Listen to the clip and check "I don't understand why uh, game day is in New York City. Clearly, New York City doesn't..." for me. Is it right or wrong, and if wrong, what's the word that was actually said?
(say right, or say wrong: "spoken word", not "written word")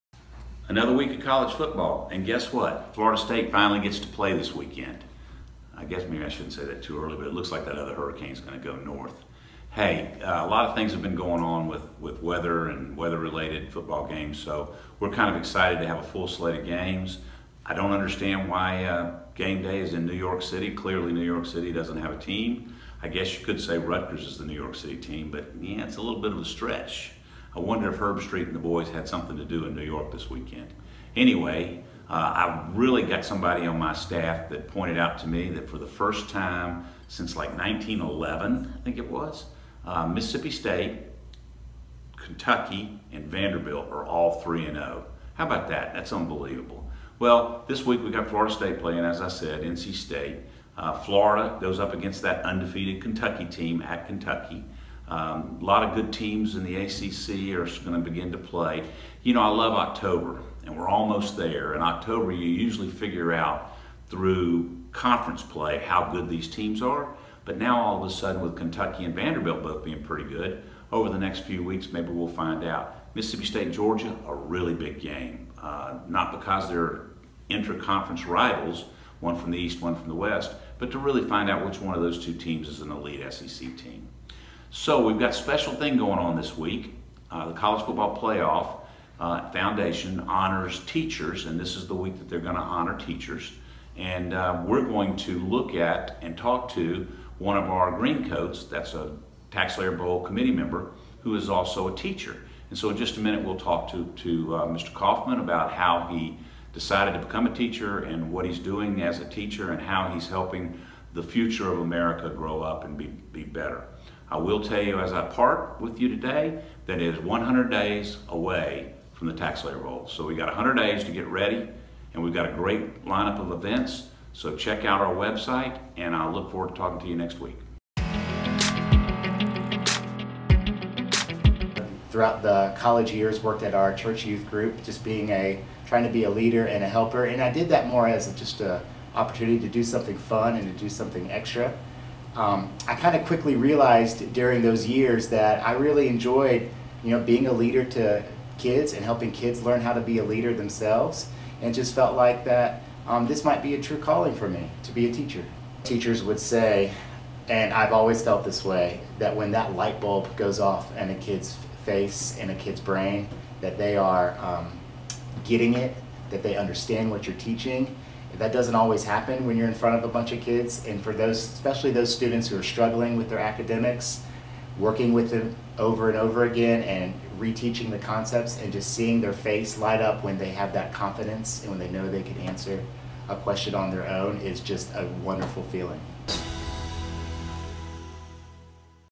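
right.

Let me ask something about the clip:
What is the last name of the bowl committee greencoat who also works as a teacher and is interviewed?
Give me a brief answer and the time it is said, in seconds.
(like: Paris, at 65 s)
Kaufman, at 104 s.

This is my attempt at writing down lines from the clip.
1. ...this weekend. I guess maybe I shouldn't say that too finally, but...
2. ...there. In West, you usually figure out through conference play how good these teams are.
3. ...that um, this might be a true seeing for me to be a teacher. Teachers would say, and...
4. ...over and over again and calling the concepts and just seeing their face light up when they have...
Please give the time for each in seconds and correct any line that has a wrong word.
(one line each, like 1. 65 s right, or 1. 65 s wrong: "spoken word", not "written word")
1. 4 s wrong: "early", not "finally"
2. 61 s wrong: "October", not "West"
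3. 152 s wrong: "calling", not "seeing"
4. 175 s wrong: "reteaching", not "calling".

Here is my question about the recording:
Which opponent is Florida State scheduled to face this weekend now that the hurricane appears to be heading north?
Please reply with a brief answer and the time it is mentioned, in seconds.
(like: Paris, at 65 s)
NC State, at 49 s.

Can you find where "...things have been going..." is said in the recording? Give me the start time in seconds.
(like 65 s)
10 s.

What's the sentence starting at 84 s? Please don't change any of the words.
So we've got a special thing going on this week.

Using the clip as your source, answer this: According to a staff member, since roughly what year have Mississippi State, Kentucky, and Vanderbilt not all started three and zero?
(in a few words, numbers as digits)
1911.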